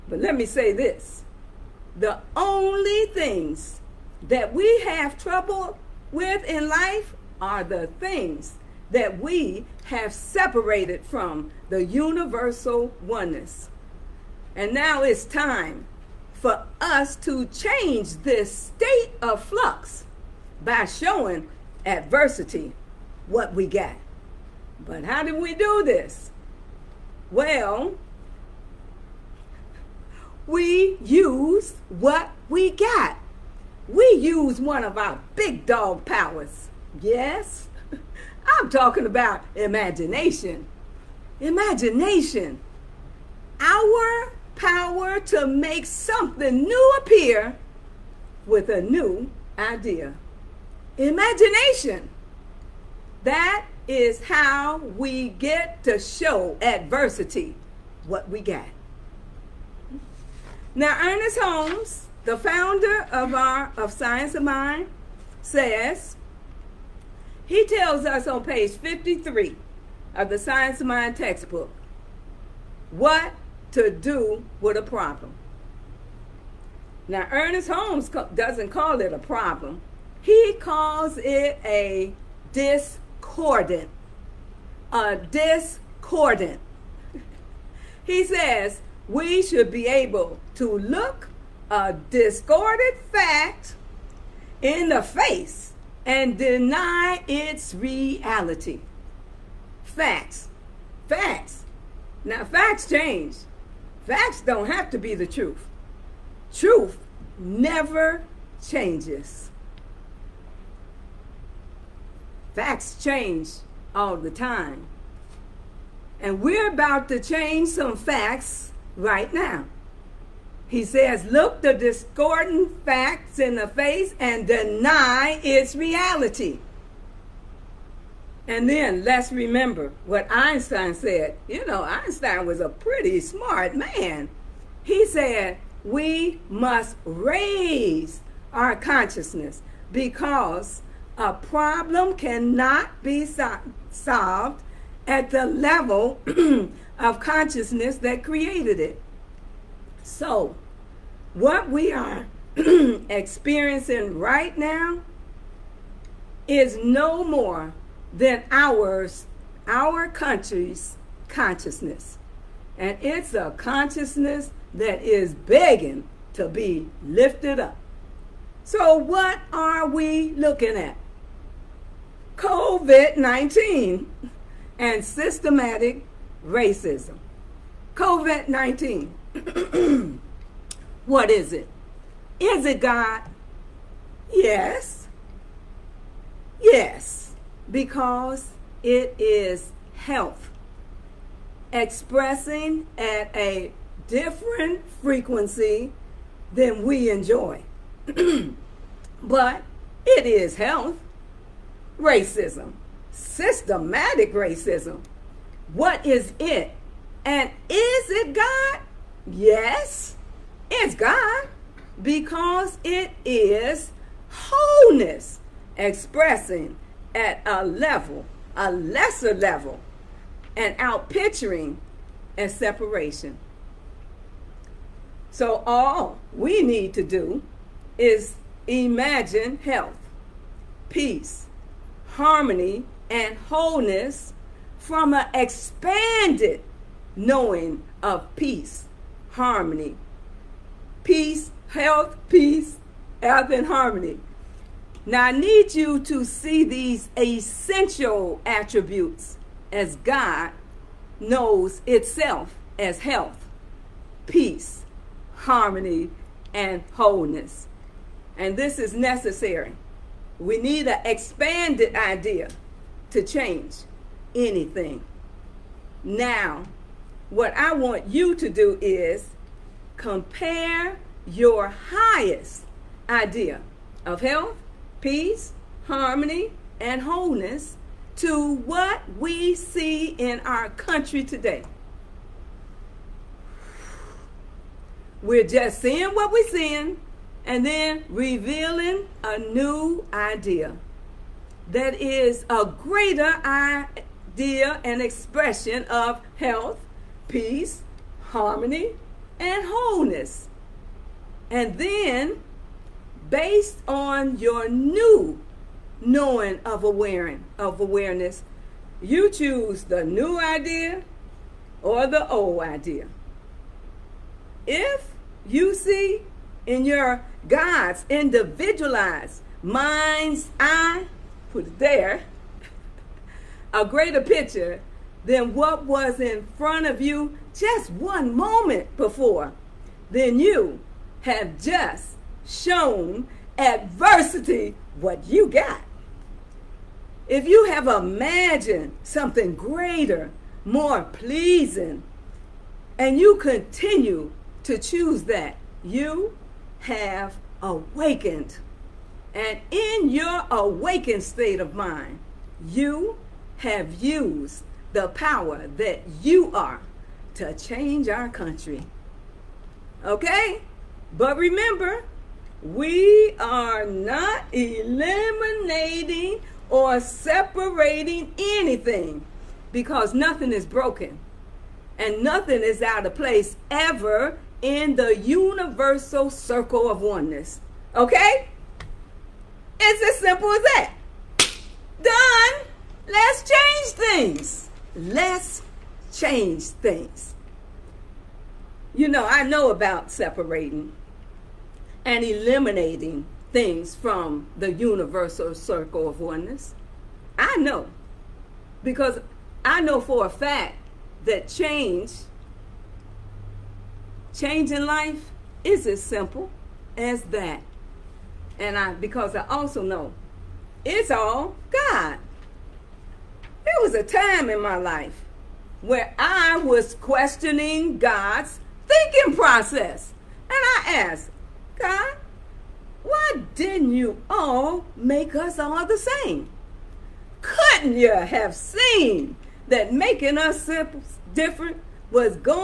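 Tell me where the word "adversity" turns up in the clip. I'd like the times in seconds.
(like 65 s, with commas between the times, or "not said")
21 s, 56 s, 333 s.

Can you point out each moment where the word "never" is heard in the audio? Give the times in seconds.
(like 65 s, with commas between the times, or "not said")
107 s.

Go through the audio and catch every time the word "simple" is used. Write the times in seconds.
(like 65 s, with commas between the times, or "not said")
380 s, 406 s.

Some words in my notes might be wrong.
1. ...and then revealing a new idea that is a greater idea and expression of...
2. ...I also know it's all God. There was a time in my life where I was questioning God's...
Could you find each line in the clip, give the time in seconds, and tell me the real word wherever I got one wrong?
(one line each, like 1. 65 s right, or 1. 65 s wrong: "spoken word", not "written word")
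1. 287 s right
2. 409 s right.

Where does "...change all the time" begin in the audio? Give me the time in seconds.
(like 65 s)
113 s.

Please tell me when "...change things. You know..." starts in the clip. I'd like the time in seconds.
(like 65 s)
386 s.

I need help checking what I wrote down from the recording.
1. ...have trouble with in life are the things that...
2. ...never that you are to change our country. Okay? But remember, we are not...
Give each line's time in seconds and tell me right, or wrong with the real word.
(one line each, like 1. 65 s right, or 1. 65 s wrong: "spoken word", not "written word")
1. 4 s right
2. 355 s wrong: "power", not "never".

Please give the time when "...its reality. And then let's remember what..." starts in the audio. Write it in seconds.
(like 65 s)
125 s.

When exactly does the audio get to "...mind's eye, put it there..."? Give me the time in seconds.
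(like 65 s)
319 s.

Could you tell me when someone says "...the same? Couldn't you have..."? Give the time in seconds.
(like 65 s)
425 s.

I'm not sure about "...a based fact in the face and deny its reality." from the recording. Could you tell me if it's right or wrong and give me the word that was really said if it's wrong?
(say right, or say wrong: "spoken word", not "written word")
wrong: "discorded", not "based".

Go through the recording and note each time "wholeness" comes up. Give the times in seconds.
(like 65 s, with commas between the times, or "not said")
214 s, 233 s, 256 s, 277 s, 299 s.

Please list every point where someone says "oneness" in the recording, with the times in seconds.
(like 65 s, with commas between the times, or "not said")
13 s, 377 s, 396 s.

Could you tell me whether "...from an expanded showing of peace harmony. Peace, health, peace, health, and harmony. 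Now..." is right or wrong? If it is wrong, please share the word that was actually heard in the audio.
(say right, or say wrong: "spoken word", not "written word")
wrong: "knowing", not "showing".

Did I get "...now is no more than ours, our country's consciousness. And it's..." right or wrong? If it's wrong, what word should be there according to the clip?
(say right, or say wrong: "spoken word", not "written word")
right.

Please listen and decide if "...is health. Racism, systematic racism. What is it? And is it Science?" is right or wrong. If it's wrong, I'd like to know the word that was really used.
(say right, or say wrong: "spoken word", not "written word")
wrong: "God", not "Science".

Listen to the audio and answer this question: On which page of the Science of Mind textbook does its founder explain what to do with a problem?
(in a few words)
53.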